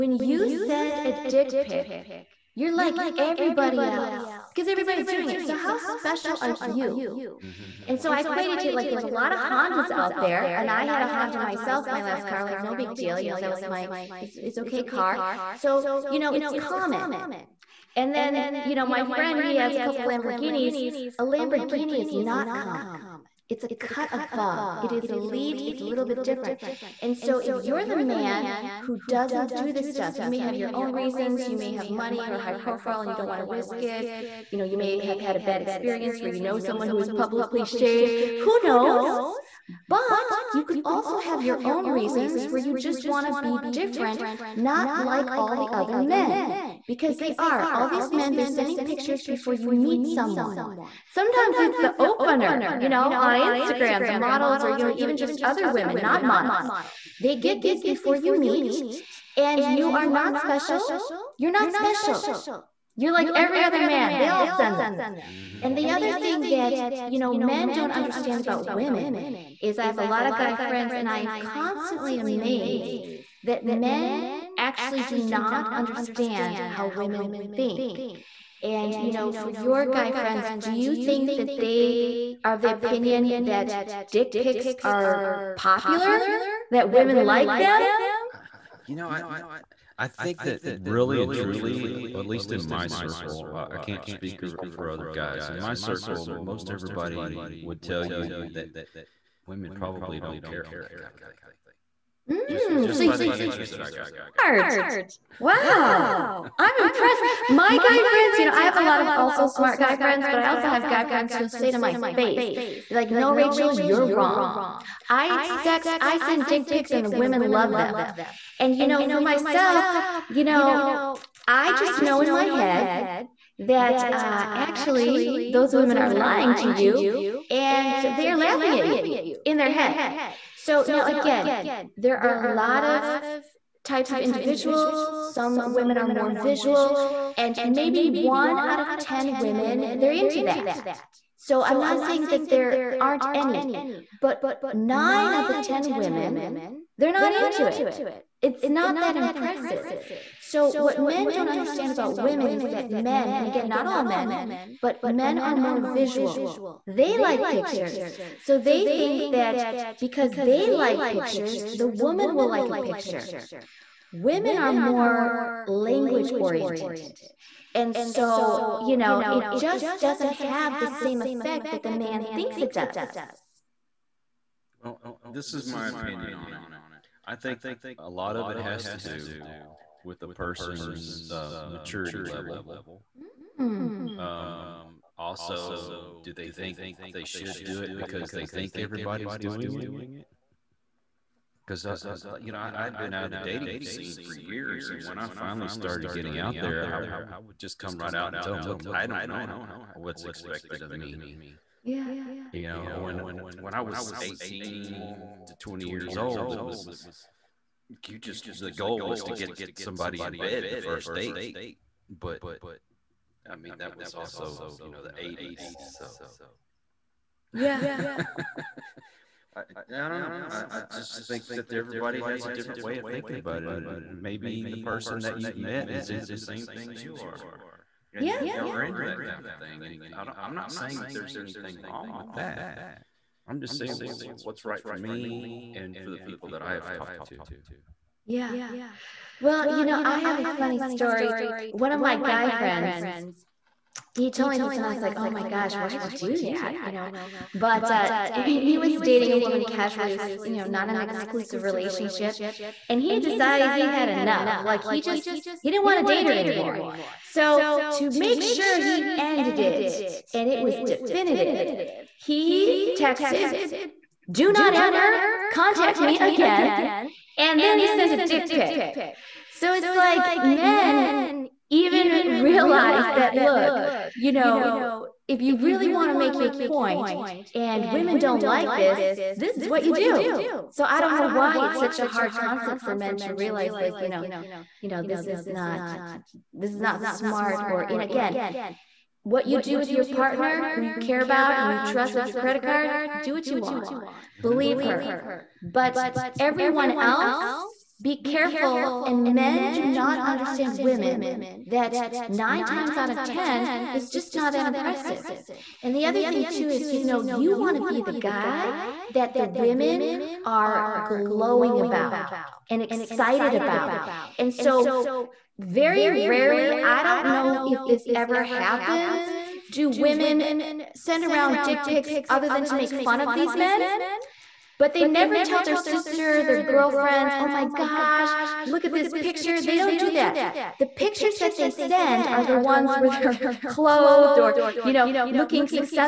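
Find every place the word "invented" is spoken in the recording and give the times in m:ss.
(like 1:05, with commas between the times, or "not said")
not said.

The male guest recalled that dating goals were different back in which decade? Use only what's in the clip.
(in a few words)
the 1980s.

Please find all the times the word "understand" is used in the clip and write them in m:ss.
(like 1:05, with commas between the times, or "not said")
1:07, 1:15, 2:31, 5:00.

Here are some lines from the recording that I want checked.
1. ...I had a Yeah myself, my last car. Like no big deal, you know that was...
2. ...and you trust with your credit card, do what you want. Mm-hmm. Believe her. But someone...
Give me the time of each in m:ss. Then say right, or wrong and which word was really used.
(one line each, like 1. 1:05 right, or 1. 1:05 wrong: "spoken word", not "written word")
1. 0:10 wrong: "Honda", not "Yeah"
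2. 4:51 wrong: "everyone", not "someone".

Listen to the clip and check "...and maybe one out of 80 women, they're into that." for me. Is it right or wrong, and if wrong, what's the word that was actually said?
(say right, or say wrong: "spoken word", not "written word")
wrong: "10", not "80".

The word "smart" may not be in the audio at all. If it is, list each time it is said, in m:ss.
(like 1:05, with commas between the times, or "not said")
1:44, 1:49, 4:47.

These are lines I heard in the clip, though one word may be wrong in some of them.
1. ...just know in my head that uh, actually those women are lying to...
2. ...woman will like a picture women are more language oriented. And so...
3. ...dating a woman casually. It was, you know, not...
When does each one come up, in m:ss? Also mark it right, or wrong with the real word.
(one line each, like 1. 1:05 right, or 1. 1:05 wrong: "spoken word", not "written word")
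1. 2:01 right
2. 2:41 right
3. 4:08 right.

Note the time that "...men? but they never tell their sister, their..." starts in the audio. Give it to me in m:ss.
5:23.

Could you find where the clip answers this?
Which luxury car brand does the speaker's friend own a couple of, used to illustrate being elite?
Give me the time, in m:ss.
0:19.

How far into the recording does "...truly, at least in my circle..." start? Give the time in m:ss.
1:31.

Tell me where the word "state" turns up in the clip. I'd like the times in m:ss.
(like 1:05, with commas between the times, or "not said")
not said.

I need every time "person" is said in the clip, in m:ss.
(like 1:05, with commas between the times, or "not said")
3:00, 3:44.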